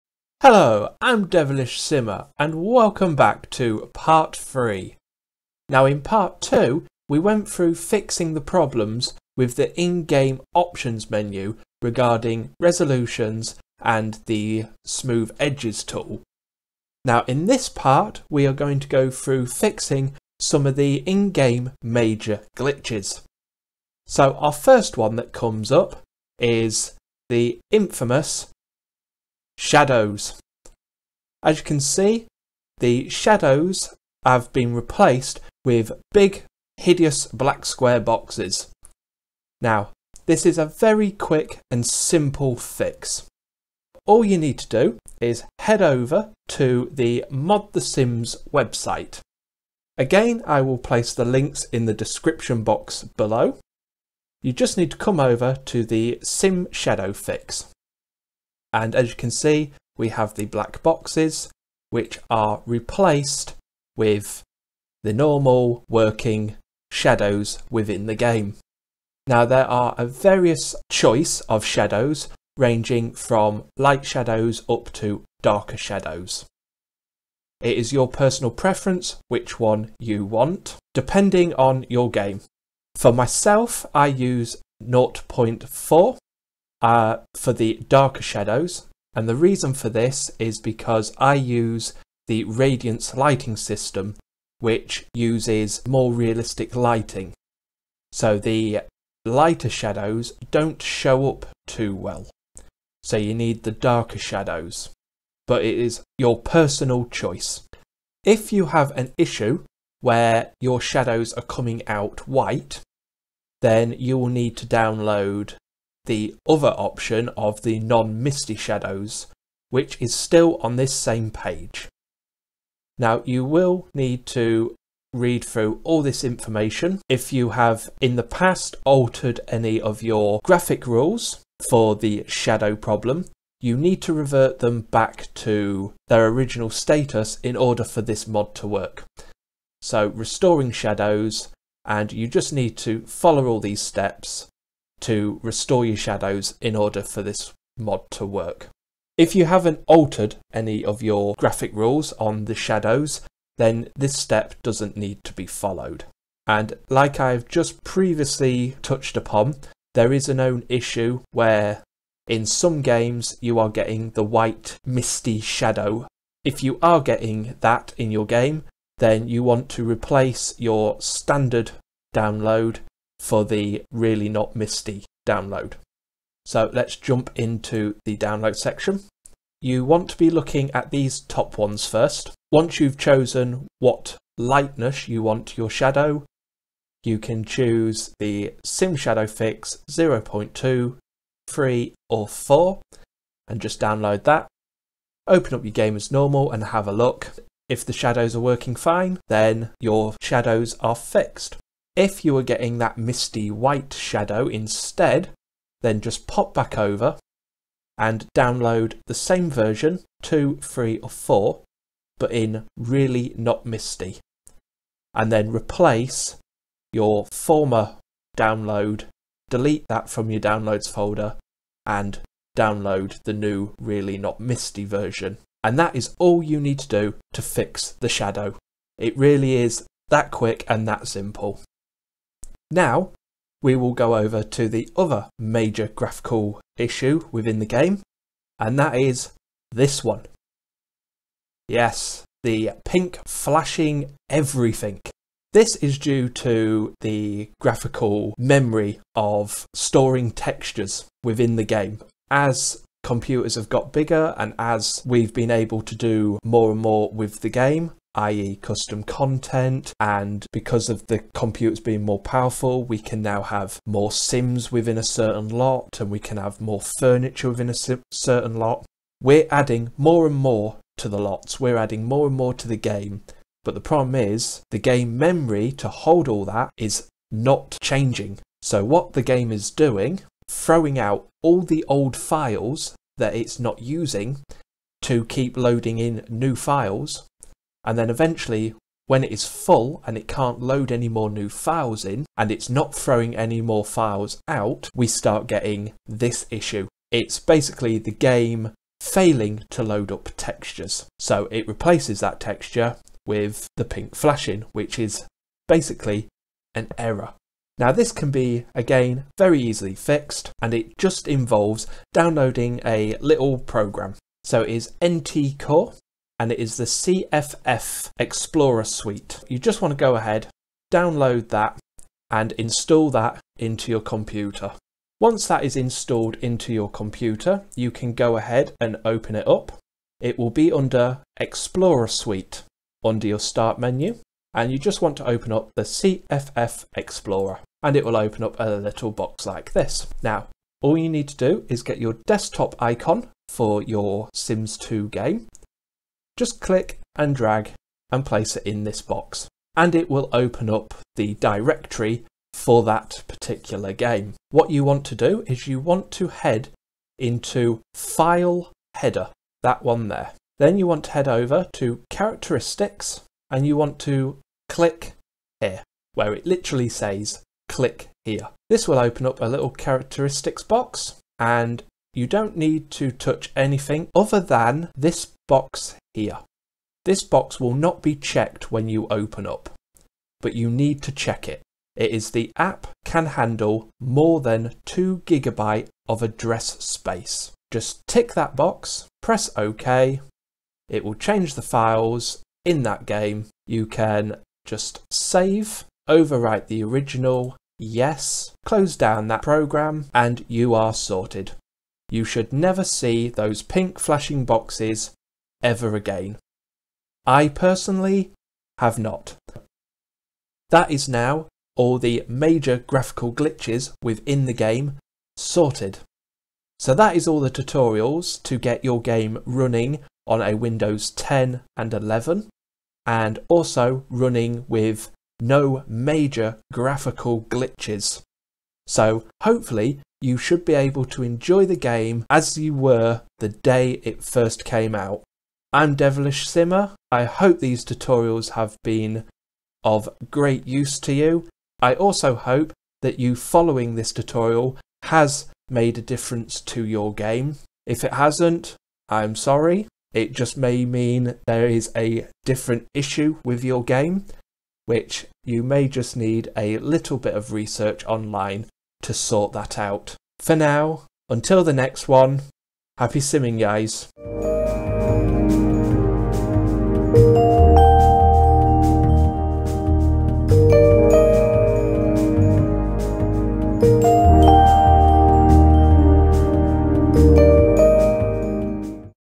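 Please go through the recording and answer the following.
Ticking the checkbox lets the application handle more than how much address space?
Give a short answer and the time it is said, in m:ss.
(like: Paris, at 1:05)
2 gigabytes, at 6:24.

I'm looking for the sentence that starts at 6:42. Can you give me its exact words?
You should never see those pink flashing boxes ever again.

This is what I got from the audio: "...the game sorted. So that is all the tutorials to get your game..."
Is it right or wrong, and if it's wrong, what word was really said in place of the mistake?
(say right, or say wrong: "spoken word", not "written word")
right.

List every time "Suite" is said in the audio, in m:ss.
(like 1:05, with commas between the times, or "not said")
5:18, 5:32.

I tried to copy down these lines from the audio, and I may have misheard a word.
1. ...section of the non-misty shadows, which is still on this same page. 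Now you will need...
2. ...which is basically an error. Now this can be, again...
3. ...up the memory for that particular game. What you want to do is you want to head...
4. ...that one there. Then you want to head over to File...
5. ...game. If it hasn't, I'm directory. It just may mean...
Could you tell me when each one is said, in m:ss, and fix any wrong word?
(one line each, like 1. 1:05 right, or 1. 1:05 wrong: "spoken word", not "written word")
1. 1:56 wrong: "option", not "section"
2. 5:04 right
3. 5:50 wrong: "directory", not "memory"
4. 5:59 wrong: "Characteristics", not "File"
5. 7:27 wrong: "sorry", not "directory".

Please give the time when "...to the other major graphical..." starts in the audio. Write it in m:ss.
3:54.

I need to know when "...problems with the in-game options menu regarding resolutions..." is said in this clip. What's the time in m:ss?
0:08.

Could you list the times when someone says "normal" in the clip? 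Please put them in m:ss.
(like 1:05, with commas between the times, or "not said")
1:05, 3:16.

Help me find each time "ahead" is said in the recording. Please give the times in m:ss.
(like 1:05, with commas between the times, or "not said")
5:20, 5:28.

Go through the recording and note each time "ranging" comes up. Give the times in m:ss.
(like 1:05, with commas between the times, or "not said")
1:12.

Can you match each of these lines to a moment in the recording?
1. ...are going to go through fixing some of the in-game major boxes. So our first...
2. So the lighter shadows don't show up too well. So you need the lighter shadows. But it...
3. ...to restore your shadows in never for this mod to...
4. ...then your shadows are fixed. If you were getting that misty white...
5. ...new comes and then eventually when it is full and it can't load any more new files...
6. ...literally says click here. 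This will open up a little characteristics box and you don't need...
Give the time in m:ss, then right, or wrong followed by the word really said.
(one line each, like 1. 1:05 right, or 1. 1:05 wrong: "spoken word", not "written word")
1. 0:18 wrong: "glitches", not "boxes"
2. 1:38 wrong: "darker", not "lighter"
3. 2:25 wrong: "order", not "never"
4. 3:19 right
5. 4:46 wrong: "files", not "comes"
6. 6:06 right.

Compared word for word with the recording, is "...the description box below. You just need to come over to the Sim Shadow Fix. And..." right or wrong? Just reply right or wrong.
right.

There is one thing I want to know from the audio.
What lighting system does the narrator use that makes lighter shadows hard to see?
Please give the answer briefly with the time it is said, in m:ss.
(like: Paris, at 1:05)
Radiance, at 1:32.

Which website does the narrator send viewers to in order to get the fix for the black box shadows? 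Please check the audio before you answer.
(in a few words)
Mod The Sims.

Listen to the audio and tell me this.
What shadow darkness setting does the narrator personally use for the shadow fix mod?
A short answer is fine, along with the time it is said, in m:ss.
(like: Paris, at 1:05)
0.4, at 1:24.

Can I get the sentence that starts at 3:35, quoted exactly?
And then replace your former download, delete that from your downloads folder and download the new really not misty version.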